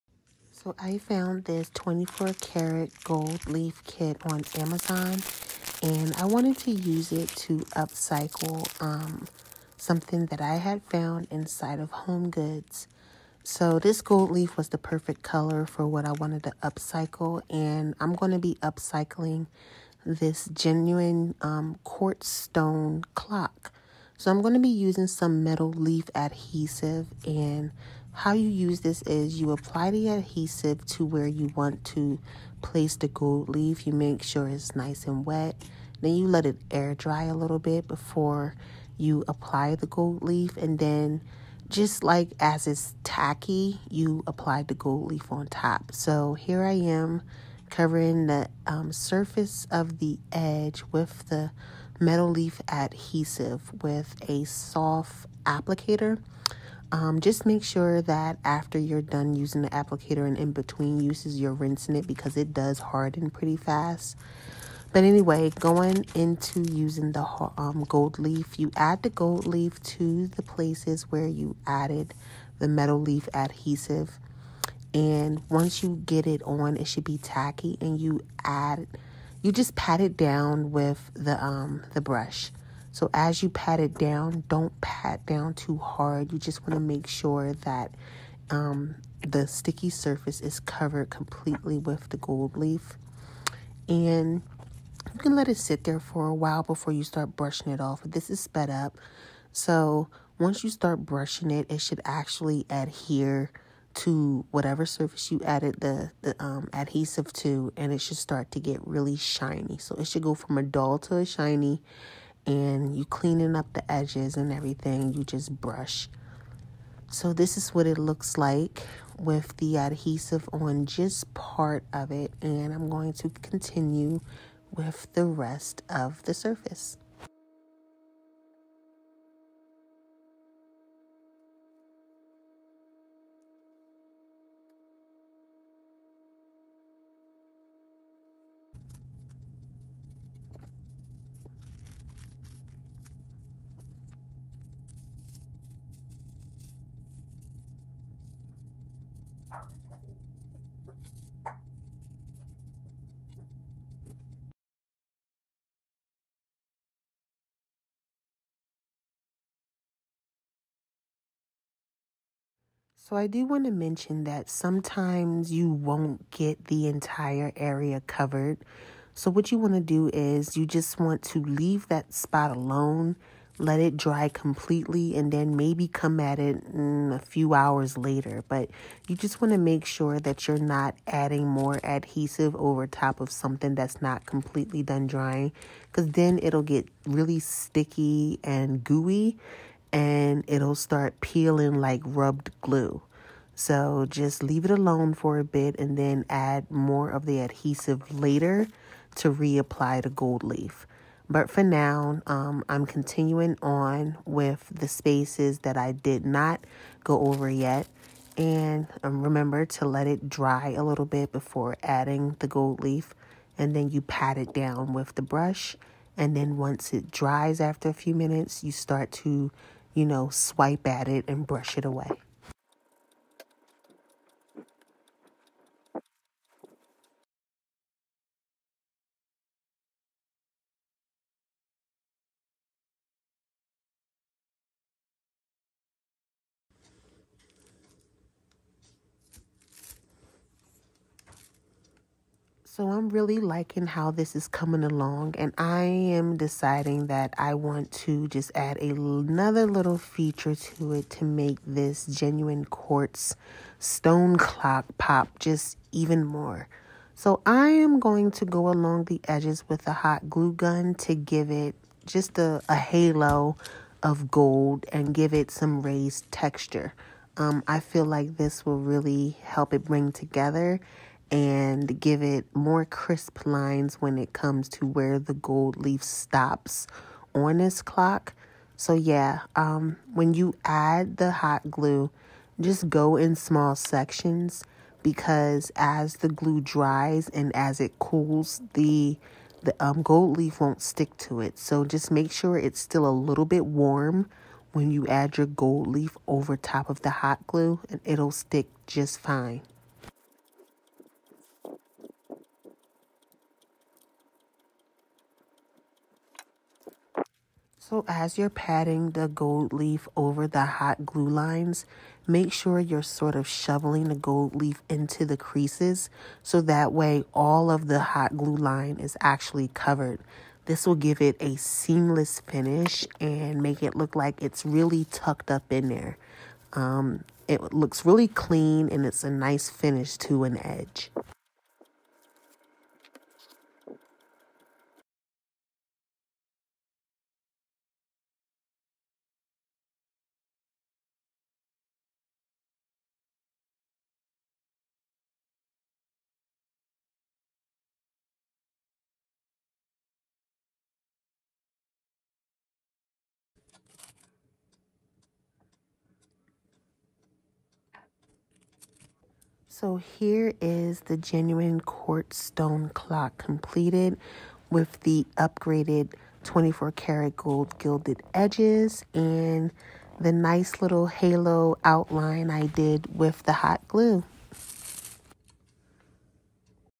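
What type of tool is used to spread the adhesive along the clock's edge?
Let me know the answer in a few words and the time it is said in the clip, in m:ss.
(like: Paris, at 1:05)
Soft applicator, at 0:54.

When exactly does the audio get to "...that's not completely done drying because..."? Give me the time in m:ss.
3:03.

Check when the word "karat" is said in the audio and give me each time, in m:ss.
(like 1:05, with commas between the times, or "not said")
0:02, 6:06.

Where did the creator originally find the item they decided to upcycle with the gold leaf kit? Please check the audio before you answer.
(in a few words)
Home Goods.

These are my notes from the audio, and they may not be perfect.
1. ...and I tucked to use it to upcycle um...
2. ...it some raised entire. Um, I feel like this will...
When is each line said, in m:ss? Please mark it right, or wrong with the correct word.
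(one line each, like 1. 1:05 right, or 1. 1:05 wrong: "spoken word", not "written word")
1. 0:05 wrong: "wanted", not "tucked"
2. 4:25 wrong: "texture", not "entire".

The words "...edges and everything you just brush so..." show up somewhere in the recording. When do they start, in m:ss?
1:53.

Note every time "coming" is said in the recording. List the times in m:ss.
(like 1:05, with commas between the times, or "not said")
4:04.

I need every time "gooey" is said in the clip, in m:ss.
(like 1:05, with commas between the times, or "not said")
3:08.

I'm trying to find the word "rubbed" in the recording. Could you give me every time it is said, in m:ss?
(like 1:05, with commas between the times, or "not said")
3:12.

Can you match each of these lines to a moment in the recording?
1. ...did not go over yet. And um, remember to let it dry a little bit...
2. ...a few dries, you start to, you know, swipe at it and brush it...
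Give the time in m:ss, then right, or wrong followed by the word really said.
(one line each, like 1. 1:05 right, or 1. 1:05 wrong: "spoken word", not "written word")
1. 3:25 right
2. 3:37 wrong: "minutes", not "dries".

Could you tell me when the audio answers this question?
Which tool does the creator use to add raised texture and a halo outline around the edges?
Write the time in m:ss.
4:19.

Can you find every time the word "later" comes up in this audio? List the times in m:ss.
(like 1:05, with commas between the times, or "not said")
2:57, 3:18.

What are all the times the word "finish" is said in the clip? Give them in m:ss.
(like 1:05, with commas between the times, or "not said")
5:22, 5:29.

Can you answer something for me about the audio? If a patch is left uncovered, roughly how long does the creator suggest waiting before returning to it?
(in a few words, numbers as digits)
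A few hours.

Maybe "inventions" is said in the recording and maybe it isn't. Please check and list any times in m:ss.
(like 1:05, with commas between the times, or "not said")
not said.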